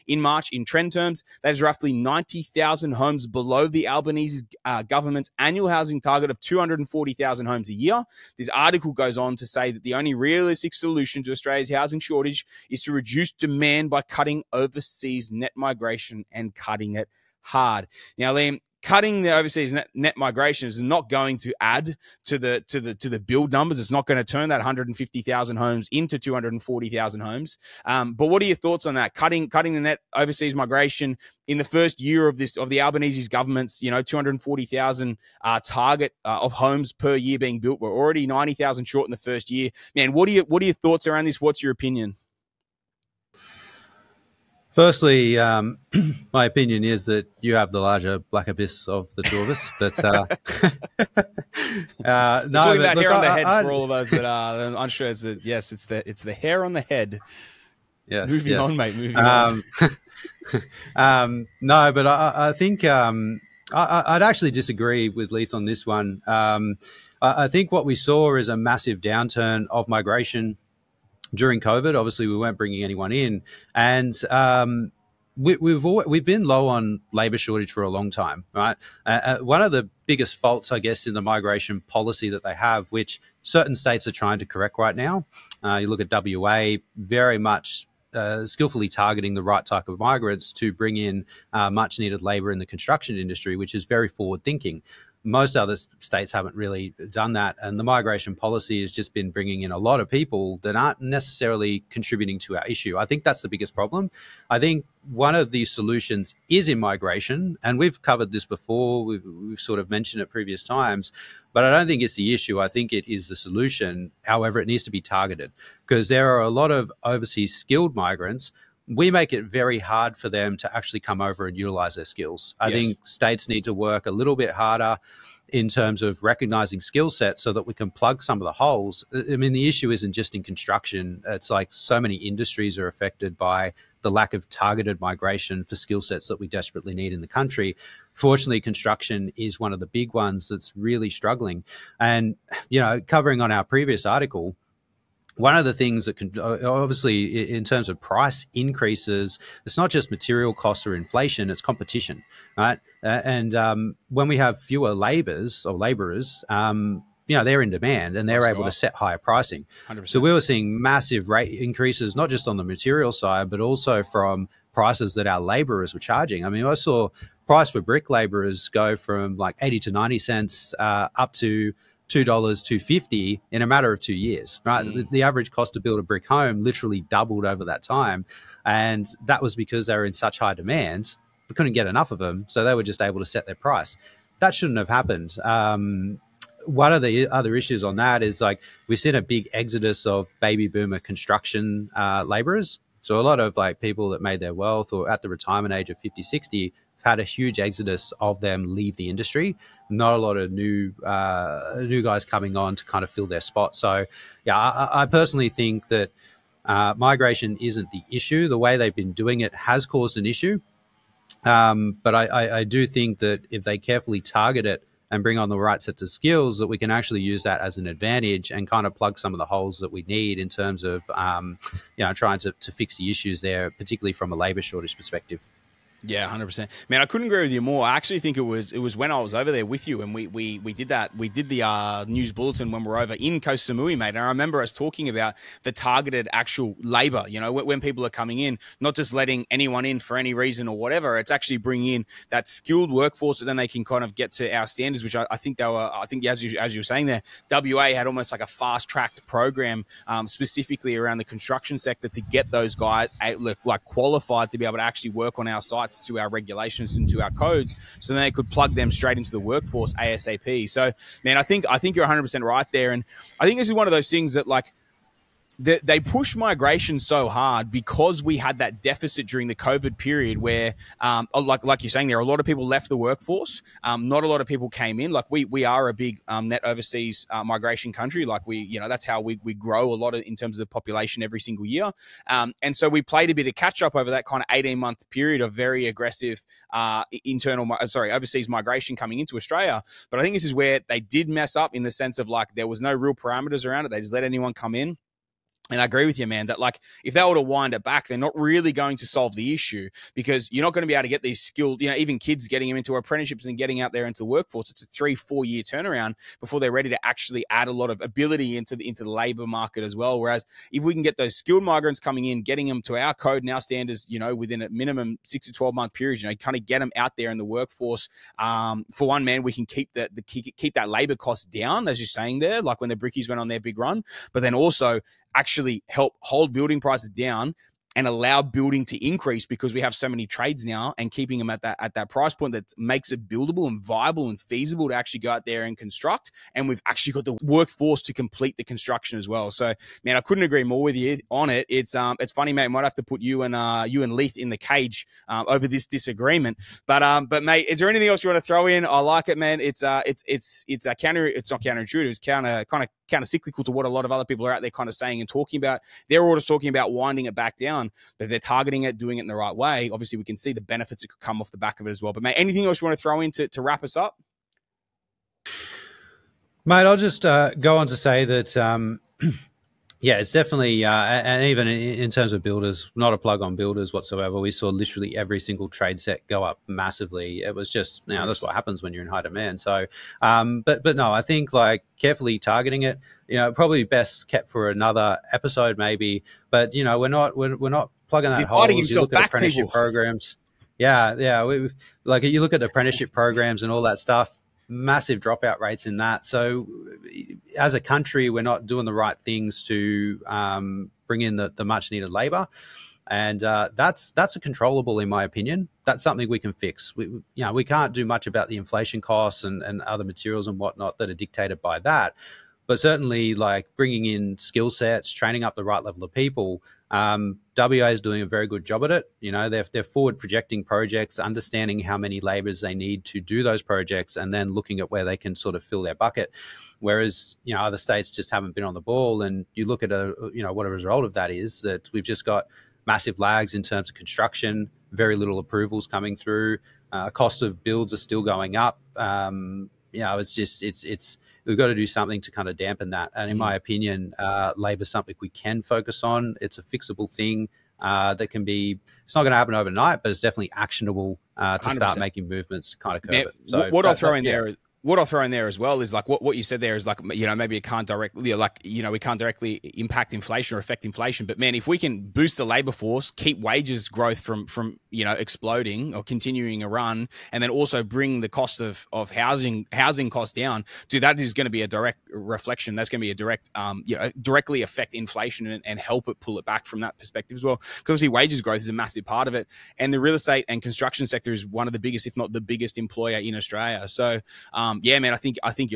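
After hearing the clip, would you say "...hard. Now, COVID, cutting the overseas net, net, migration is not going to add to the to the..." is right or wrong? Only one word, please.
wrong.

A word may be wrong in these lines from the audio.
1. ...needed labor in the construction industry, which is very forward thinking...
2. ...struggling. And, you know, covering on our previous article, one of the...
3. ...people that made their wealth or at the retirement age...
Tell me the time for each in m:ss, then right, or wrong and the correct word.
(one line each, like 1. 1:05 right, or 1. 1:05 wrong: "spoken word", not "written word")
1. 1:31 right
2. 2:21 right
3. 3:13 right.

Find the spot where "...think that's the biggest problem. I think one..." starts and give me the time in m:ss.
1:43.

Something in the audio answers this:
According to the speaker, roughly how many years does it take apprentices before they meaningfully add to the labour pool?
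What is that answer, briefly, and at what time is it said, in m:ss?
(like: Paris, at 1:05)
3 to 4 years, at 5:04.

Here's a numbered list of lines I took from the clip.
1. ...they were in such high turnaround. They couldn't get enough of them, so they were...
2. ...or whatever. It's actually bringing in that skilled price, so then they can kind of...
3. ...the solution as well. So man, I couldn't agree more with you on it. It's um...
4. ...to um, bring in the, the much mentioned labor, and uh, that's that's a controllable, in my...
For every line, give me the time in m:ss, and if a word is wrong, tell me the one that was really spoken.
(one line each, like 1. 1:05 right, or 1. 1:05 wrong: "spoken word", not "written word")
1. 2:59 wrong: "demand", not "turnaround"
2. 4:00 wrong: "workforce", not "price"
3. 5:38 wrong: "construction", not "solution"
4. 6:39 wrong: "needed", not "mentioned".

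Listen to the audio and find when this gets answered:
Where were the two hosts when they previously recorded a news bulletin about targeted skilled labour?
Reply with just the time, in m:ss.
3:53.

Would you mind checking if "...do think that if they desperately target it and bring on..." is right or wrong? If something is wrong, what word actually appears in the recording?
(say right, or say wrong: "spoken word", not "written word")
wrong: "carefully", not "desperately".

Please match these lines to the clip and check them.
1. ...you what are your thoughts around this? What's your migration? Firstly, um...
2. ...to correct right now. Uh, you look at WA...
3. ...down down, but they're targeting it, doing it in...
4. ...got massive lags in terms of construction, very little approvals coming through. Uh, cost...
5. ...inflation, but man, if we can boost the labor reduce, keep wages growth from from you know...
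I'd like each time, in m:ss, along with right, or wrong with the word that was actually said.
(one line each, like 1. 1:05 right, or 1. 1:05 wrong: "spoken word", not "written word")
1. 0:40 wrong: "opinion", not "migration"
2. 1:24 right
3. 5:57 right
4. 7:12 right
5. 7:40 wrong: "force", not "reduce".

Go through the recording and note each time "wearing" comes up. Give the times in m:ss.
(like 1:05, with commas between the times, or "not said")
not said.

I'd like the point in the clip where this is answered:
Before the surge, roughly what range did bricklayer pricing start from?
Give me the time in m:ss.
2:49.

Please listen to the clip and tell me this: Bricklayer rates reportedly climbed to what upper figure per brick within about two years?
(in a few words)
$2.50.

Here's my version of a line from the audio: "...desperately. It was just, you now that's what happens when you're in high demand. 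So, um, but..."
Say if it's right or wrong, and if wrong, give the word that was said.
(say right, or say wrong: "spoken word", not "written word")
wrong: "massively", not "desperately".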